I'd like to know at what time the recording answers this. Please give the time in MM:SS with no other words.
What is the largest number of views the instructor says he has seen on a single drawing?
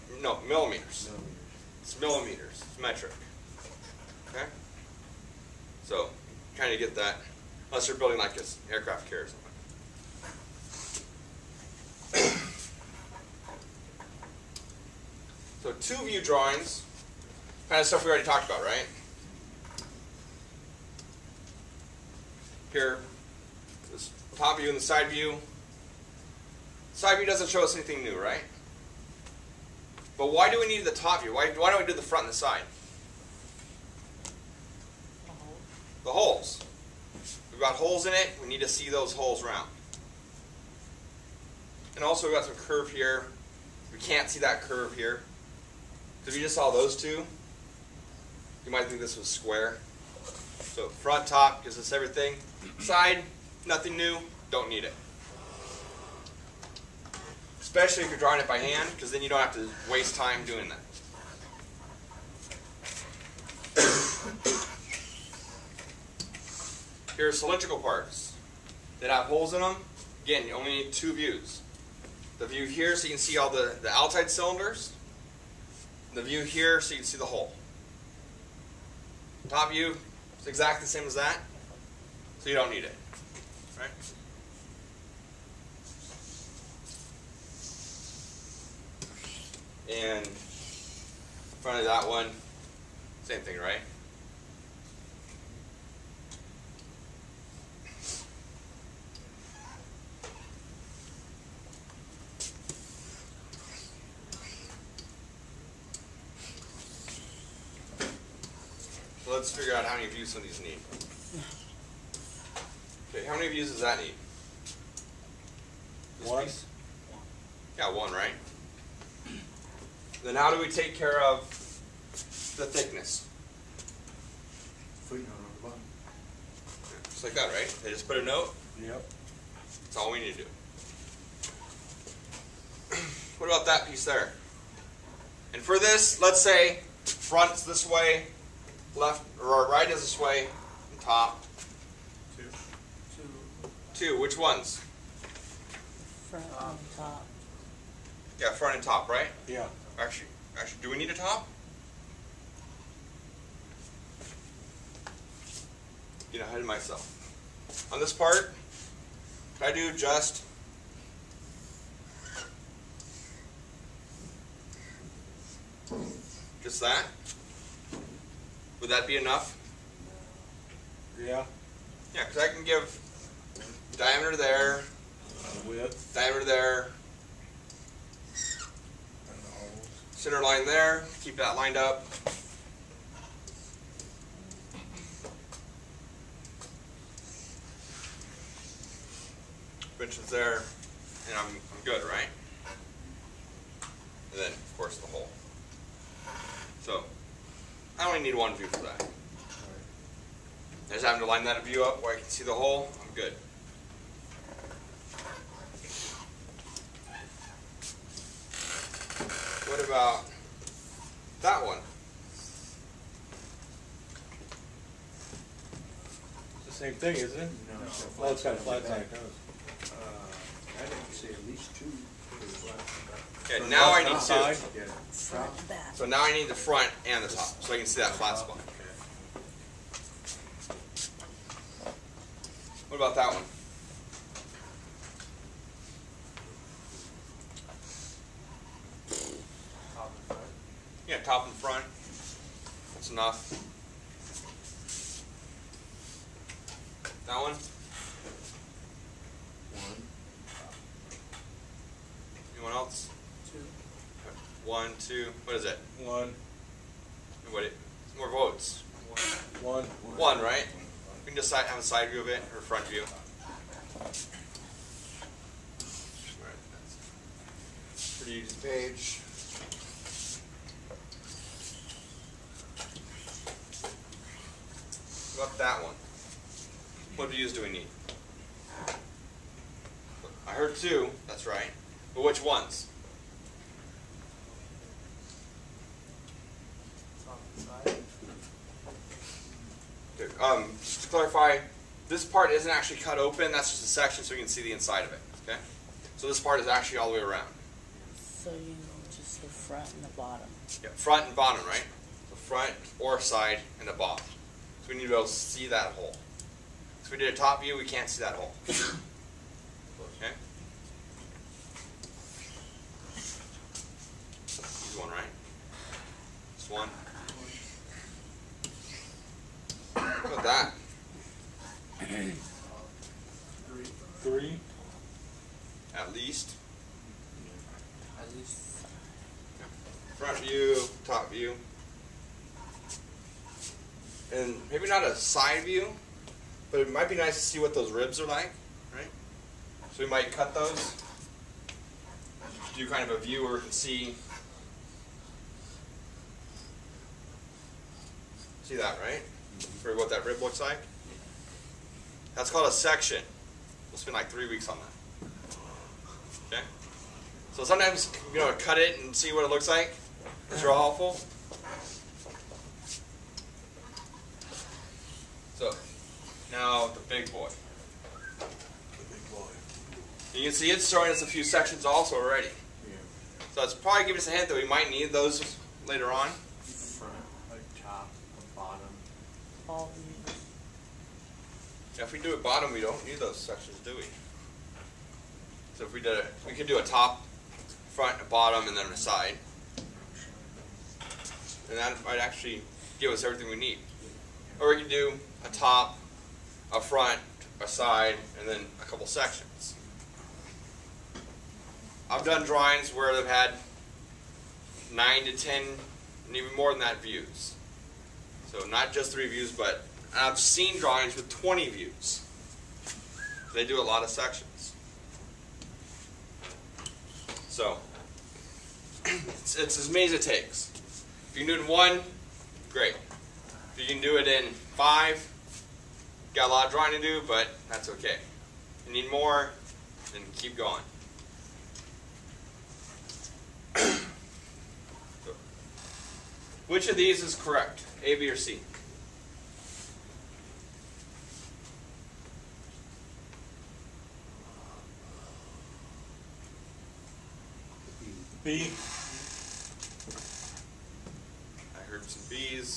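06:51.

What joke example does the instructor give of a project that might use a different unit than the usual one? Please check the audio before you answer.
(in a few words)
an aircraft carrier.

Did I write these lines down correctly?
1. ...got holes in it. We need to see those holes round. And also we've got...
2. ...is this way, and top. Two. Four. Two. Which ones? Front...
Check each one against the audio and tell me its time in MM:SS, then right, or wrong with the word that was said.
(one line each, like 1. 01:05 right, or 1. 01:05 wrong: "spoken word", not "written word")
1. 00:37 right
2. 02:19 wrong: "Two", not "Four".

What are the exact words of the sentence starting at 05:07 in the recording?
So we did a top view, we can't see that hole.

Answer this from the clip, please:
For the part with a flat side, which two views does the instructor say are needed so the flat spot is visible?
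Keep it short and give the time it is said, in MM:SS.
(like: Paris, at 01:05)
front and top, at 03:46.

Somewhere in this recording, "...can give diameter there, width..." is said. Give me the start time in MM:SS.
02:52.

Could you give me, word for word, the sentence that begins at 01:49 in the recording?
let's figure out how many views some of these need.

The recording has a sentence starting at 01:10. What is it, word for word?
Again, you only need two views.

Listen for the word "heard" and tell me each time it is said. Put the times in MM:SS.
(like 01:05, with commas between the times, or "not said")
04:40, 07:31.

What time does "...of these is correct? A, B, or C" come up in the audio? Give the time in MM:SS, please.
07:16.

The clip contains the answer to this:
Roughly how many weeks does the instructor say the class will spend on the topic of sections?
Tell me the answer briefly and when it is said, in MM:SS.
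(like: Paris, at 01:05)
3, at 05:54.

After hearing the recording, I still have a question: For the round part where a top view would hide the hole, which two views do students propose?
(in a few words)
front and bottom.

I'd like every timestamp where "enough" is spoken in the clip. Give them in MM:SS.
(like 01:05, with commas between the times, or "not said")
02:49, 04:03.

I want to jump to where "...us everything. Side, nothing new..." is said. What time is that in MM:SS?
00:51.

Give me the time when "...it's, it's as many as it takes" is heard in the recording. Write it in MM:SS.
06:59.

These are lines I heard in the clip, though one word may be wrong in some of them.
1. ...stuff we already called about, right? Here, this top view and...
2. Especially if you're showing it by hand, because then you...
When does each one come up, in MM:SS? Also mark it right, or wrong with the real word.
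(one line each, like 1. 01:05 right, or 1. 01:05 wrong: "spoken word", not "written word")
1. 00:17 wrong: "talked", not "called"
2. 00:57 wrong: "drawing", not "showing".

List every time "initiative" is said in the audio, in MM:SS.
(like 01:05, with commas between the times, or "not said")
not said.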